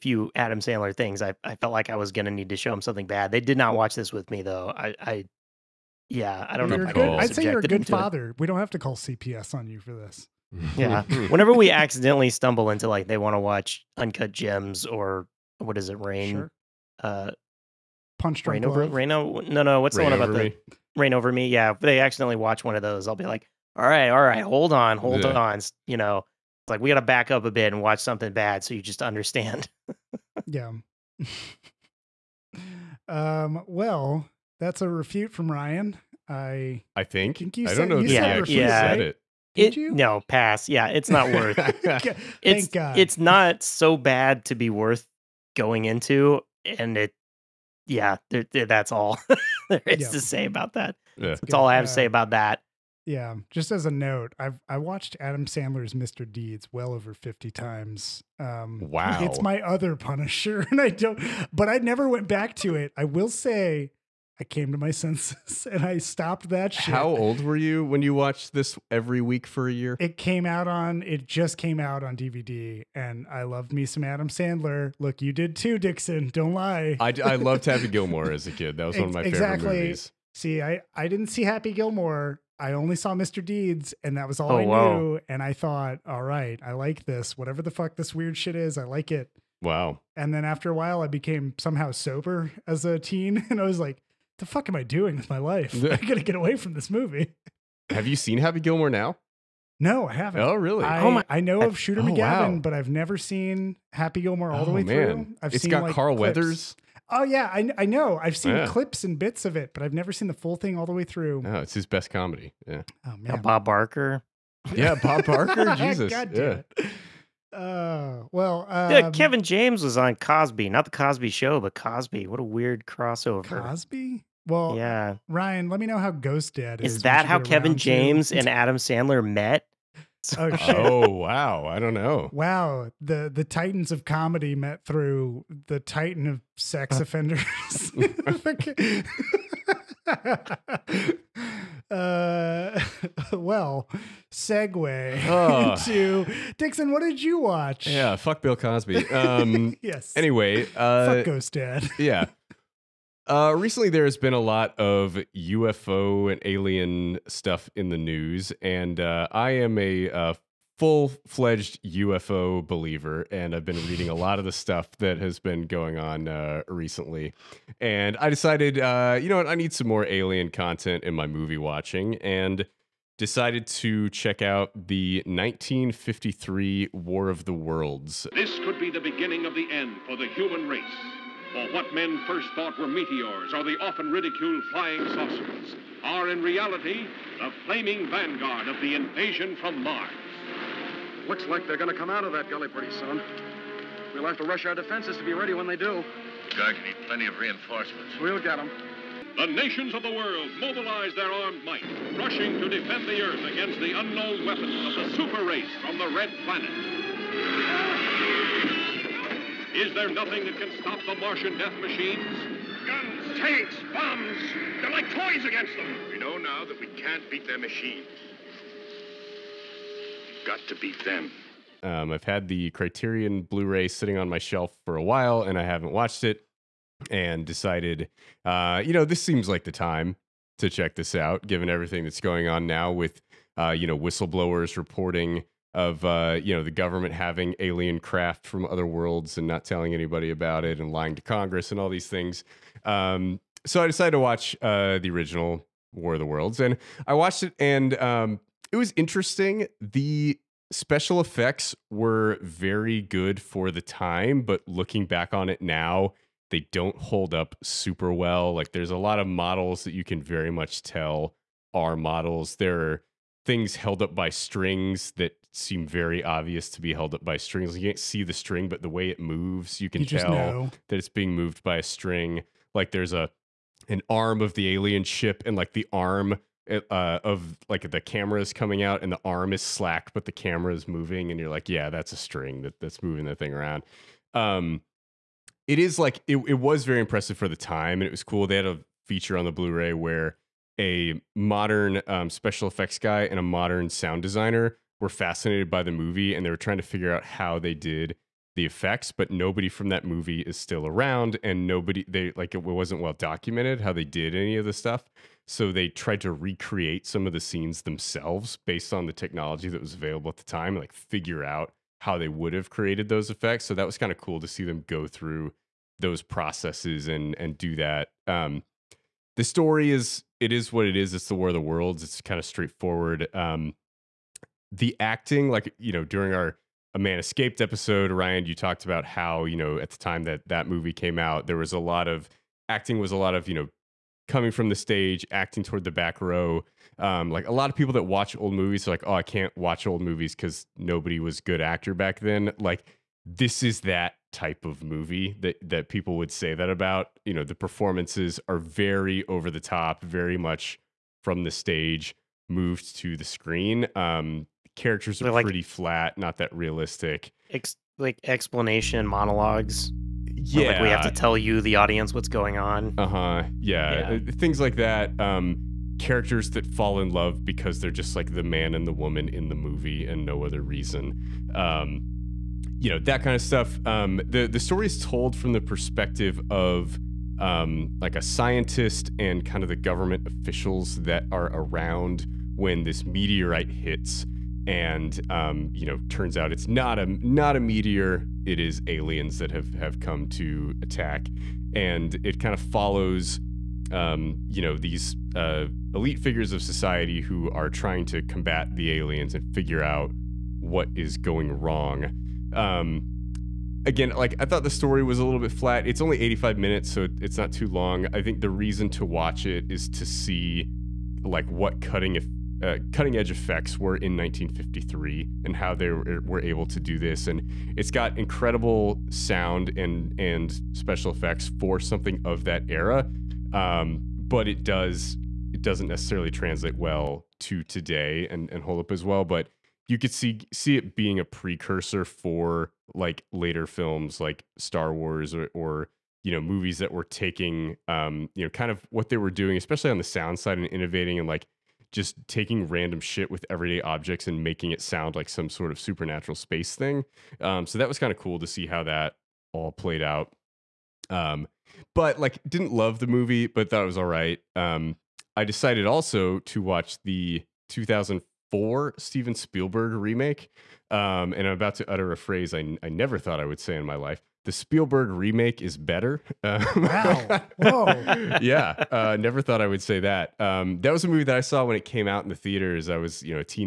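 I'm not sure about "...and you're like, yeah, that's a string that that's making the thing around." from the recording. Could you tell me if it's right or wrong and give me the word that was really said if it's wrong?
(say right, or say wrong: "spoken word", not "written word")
wrong: "moving", not "making".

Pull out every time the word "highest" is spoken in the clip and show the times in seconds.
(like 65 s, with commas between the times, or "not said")
not said.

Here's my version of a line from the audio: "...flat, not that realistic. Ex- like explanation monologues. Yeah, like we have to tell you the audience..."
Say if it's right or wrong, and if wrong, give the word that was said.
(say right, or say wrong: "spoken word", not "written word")
right.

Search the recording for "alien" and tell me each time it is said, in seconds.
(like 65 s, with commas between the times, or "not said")
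156 s, 170 s, 237 s, 274 s, 388 s, 398 s.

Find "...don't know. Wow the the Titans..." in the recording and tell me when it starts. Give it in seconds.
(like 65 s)
131 s.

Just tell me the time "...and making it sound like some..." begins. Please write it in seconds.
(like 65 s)
444 s.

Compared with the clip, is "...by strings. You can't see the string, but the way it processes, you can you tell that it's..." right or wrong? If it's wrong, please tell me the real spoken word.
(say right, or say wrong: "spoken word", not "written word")
wrong: "moves", not "processes".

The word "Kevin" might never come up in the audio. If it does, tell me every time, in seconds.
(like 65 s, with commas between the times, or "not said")
119 s, 127 s.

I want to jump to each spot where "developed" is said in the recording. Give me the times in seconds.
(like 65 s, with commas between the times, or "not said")
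not said.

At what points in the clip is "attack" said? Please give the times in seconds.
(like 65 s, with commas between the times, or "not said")
390 s.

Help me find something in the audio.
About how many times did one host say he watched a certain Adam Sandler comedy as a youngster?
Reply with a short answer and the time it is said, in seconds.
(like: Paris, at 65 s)
over 50, at 56 s.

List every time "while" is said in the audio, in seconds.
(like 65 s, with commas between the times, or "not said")
90 s, 225 s.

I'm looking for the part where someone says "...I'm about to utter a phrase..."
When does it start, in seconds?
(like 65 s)
461 s.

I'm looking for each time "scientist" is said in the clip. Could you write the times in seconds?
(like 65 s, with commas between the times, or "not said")
378 s.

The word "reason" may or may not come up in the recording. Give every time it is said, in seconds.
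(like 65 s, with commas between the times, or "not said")
370 s, 408 s.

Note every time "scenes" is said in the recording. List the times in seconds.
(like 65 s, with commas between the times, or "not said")
307 s.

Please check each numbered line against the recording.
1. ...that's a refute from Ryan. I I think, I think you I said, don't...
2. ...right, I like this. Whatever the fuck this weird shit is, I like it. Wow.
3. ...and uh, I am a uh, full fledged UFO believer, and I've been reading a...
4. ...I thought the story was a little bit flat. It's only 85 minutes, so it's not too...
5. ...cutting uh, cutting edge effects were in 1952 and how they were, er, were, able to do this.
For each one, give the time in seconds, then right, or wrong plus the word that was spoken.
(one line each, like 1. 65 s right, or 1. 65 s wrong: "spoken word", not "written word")
1. 34 s right
2. 86 s right
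3. 158 s right
4. 404 s right
5. 411 s wrong: "1953", not "1952".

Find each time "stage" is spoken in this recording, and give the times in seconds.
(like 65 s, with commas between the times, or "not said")
334 s, 351 s.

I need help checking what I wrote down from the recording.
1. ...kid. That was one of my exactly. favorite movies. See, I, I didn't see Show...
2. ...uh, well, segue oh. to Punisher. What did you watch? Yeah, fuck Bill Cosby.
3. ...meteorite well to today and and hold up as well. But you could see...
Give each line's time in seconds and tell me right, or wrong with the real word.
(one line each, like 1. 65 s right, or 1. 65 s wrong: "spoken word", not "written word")
1. 78 s wrong: "Happy", not "Show"
2. 141 s wrong: "Dixon", not "Punisher"
3. 426 s wrong: "translate", not "meteorite".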